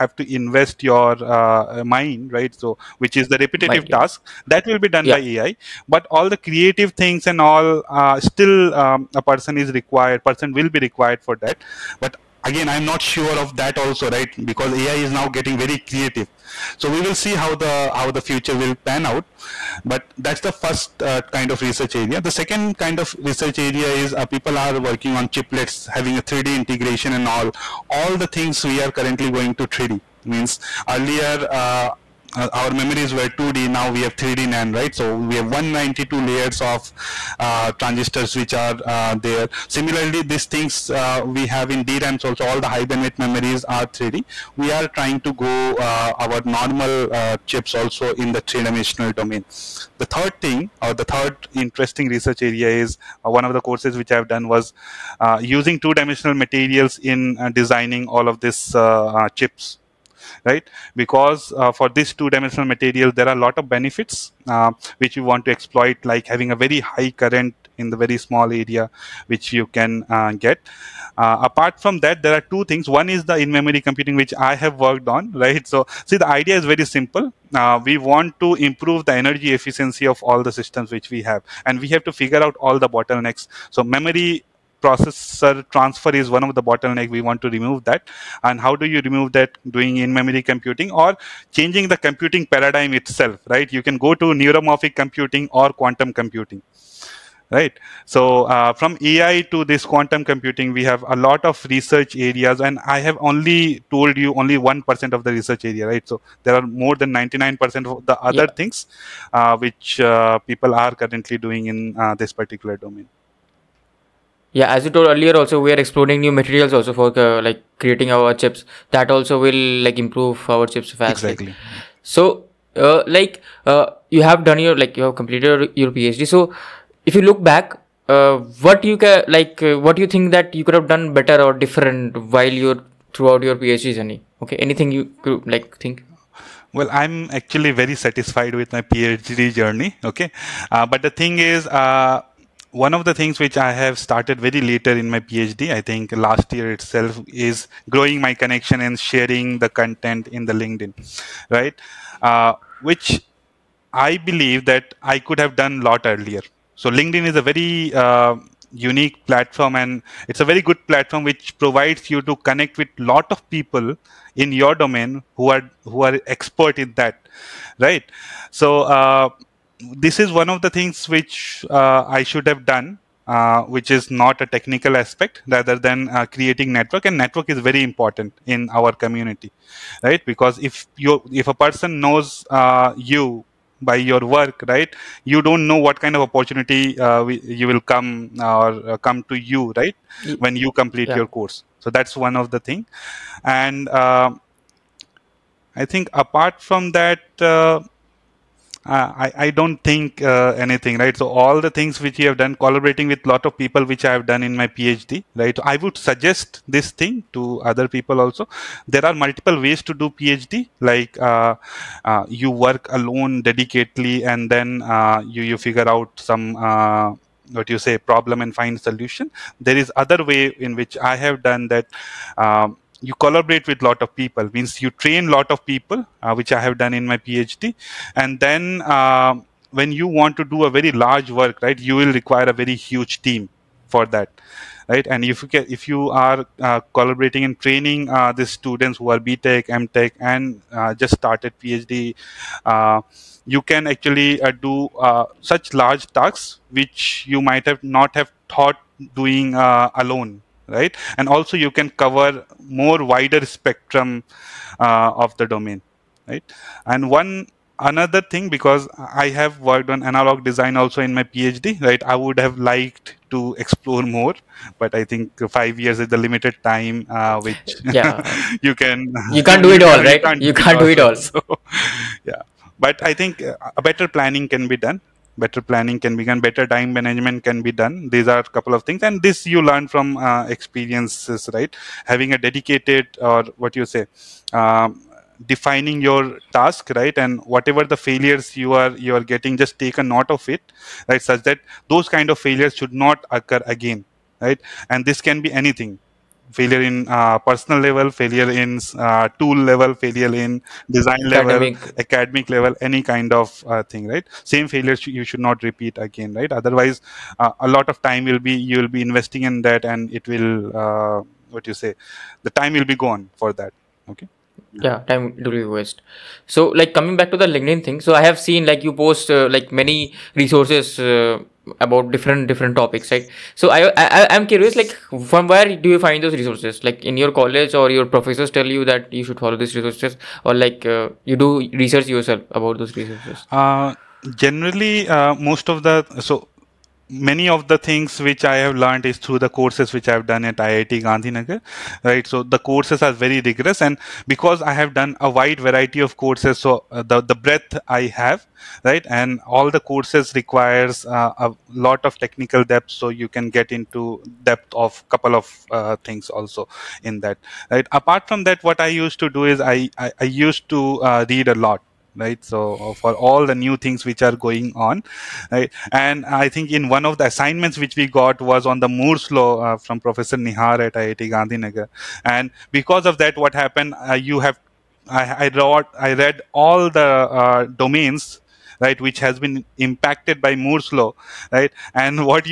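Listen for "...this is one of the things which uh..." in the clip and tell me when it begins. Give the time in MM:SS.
02:49.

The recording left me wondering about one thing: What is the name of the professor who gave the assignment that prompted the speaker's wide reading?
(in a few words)
Nihar.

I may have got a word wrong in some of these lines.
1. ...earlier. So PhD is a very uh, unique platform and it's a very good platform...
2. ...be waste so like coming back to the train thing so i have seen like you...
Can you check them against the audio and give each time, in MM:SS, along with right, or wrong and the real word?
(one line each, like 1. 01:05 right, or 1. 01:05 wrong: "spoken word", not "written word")
1. 02:36 wrong: "LinkedIn", not "PhD"
2. 05:15 wrong: "linkedin", not "train".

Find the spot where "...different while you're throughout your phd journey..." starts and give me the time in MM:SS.
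02:11.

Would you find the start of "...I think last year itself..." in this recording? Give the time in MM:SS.
02:25.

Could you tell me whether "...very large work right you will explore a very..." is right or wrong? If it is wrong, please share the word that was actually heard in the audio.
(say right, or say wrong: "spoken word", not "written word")
wrong: "require", not "explore".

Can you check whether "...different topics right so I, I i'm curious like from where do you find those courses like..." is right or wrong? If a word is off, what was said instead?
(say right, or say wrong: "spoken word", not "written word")
wrong: "resources", not "courses".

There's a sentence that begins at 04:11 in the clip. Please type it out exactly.
And also you can cover more wider spectrum uh, of the domain, right?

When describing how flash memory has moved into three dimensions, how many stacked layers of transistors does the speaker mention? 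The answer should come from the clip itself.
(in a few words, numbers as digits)
192.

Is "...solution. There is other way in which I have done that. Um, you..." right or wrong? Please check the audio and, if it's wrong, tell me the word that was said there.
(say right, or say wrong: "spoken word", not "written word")
right.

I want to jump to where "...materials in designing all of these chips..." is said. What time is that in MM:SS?
00:56.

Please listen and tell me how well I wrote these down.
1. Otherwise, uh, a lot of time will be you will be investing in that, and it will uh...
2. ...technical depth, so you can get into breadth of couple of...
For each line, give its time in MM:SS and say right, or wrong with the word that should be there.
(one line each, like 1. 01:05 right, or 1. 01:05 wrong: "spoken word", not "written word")
1. 05:06 right
2. 05:52 wrong: "depth", not "breadth".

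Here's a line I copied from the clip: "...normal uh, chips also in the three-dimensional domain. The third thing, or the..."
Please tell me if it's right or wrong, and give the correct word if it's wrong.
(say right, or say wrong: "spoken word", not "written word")
right.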